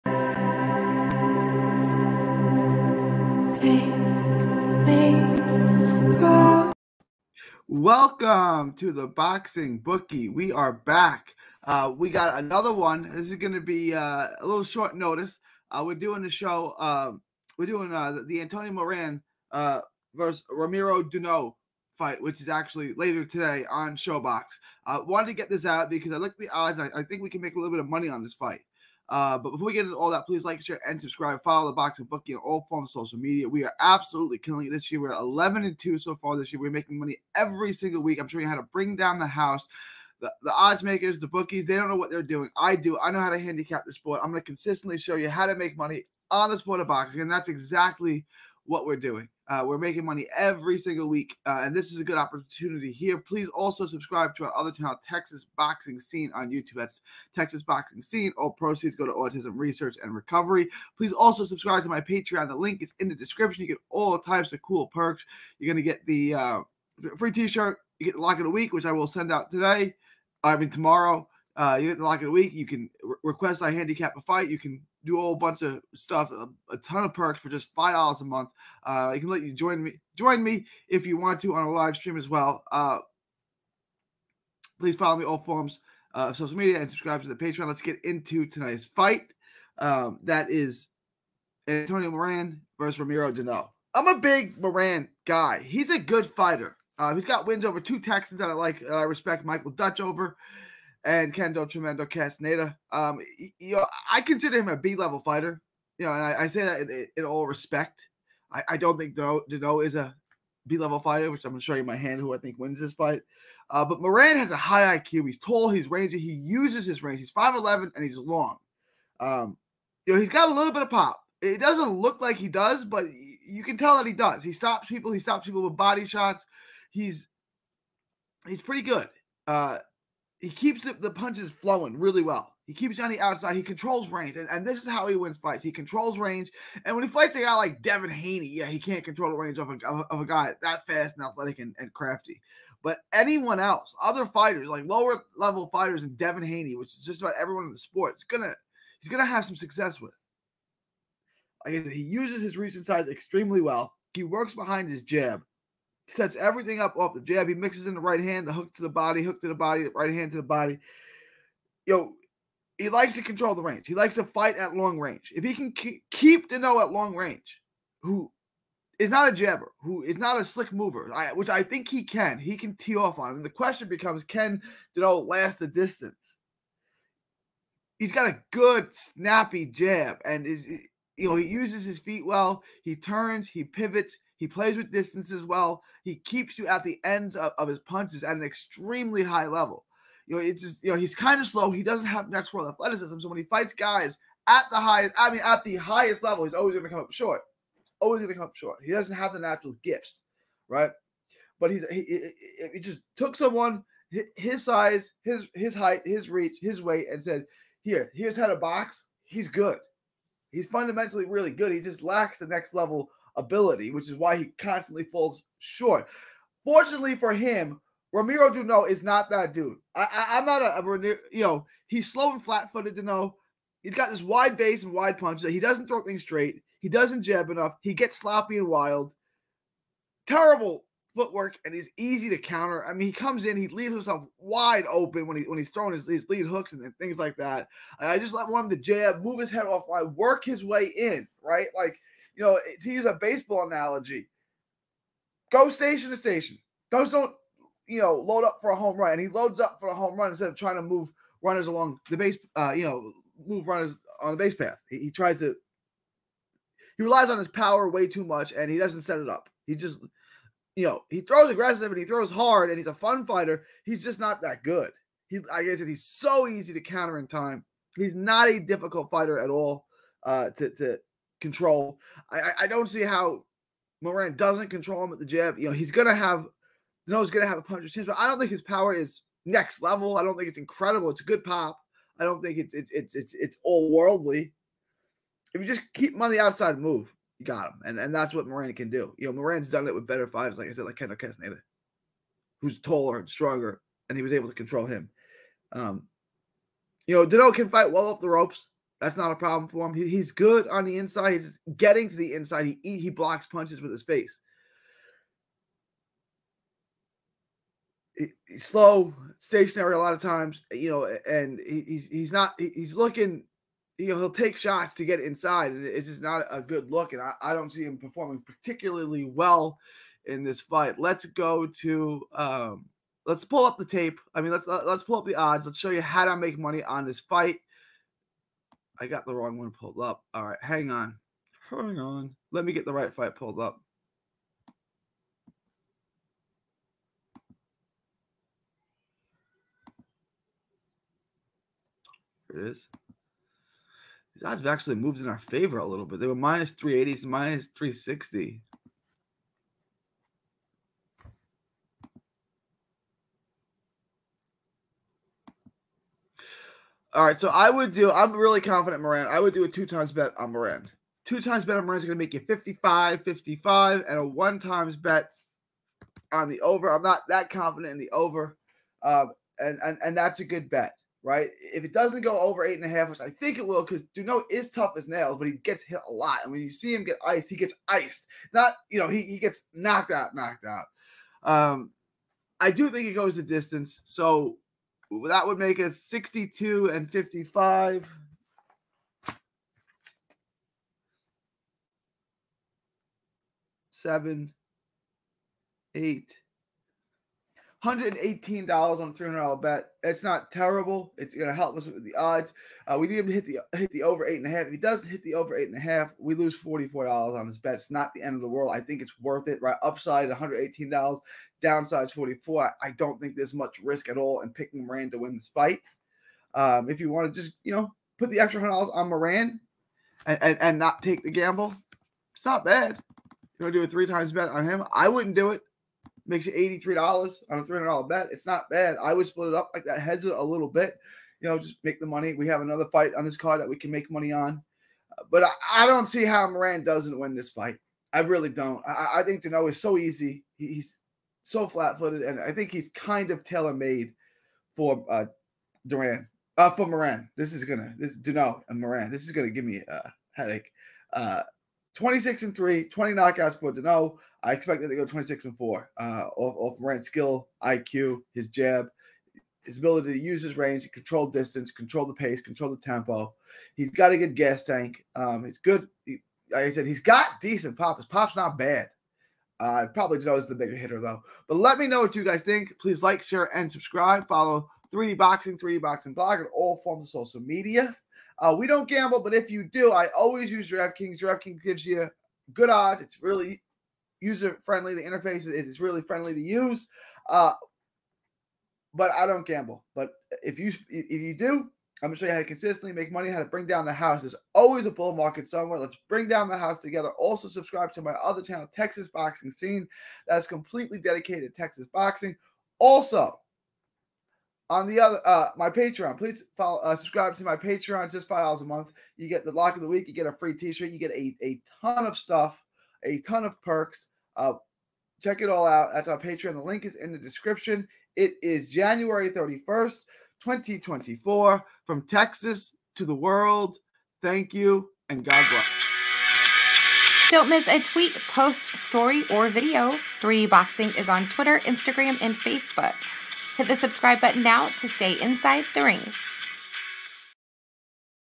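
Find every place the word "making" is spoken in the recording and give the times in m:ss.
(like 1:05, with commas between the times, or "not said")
0:36, 0:49.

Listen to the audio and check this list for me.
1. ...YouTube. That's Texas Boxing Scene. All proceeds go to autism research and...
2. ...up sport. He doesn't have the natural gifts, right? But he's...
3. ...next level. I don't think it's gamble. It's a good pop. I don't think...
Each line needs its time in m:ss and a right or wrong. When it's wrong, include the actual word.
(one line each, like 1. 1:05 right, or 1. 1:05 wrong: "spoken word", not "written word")
1. 0:56 right
2. 3:18 wrong: "short", not "sport"
3. 4:39 wrong: "incredible", not "gamble".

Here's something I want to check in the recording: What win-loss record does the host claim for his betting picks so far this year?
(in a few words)
11 and 2.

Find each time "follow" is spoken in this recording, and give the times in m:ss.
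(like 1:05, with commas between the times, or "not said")
0:31, 1:24, 7:54, 8:26.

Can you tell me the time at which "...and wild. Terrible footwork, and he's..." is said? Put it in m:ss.
3:48.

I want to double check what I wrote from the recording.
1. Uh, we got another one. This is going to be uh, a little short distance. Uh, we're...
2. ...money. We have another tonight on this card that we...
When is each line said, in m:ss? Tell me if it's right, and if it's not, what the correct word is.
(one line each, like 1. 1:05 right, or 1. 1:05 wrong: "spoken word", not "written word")
1. 0:11 wrong: "notice", not "distance"
2. 7:12 wrong: "fight", not "tonight".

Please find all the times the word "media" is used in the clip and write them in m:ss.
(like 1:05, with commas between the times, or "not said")
0:33, 1:26, 7:57.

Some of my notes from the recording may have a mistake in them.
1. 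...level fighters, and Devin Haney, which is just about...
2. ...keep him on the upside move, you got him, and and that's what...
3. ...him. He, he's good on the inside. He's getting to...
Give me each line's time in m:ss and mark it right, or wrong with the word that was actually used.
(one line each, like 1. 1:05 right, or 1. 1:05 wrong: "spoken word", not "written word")
1. 2:25 right
2. 4:45 wrong: "outside", not "upside"
3. 4:59 right.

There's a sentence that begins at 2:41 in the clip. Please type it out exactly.
Yo, he likes to control the range.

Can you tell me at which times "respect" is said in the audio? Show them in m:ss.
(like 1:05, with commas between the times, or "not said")
1:39, 1:47.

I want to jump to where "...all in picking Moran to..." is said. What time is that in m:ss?
6:54.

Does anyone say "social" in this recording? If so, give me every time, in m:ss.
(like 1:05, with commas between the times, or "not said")
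0:33, 1:26, 7:57.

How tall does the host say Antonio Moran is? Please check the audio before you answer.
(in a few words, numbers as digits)
5'11.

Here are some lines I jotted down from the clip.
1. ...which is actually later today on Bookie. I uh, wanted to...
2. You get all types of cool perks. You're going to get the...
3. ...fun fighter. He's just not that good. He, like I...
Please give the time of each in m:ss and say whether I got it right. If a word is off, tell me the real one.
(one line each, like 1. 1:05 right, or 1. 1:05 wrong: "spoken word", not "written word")
1. 0:22 wrong: "ShoBox", not "Bookie"
2. 1:03 right
3. 4:22 right.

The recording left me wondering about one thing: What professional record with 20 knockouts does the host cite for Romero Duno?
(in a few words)
26-3.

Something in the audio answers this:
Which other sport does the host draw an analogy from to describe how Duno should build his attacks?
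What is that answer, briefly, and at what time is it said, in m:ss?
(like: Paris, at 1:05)
Baseball, at 4:03.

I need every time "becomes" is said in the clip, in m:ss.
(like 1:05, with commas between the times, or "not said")
2:53.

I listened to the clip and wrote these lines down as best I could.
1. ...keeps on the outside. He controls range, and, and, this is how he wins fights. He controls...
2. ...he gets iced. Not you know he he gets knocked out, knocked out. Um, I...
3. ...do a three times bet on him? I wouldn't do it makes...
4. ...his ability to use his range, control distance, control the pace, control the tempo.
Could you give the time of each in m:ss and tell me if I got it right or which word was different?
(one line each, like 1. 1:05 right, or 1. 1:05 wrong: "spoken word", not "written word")
1. 2:12 right
2. 6:17 right
3. 7:03 right
4. 7:39 right.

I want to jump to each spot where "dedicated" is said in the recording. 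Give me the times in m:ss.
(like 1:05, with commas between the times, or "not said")
8:20.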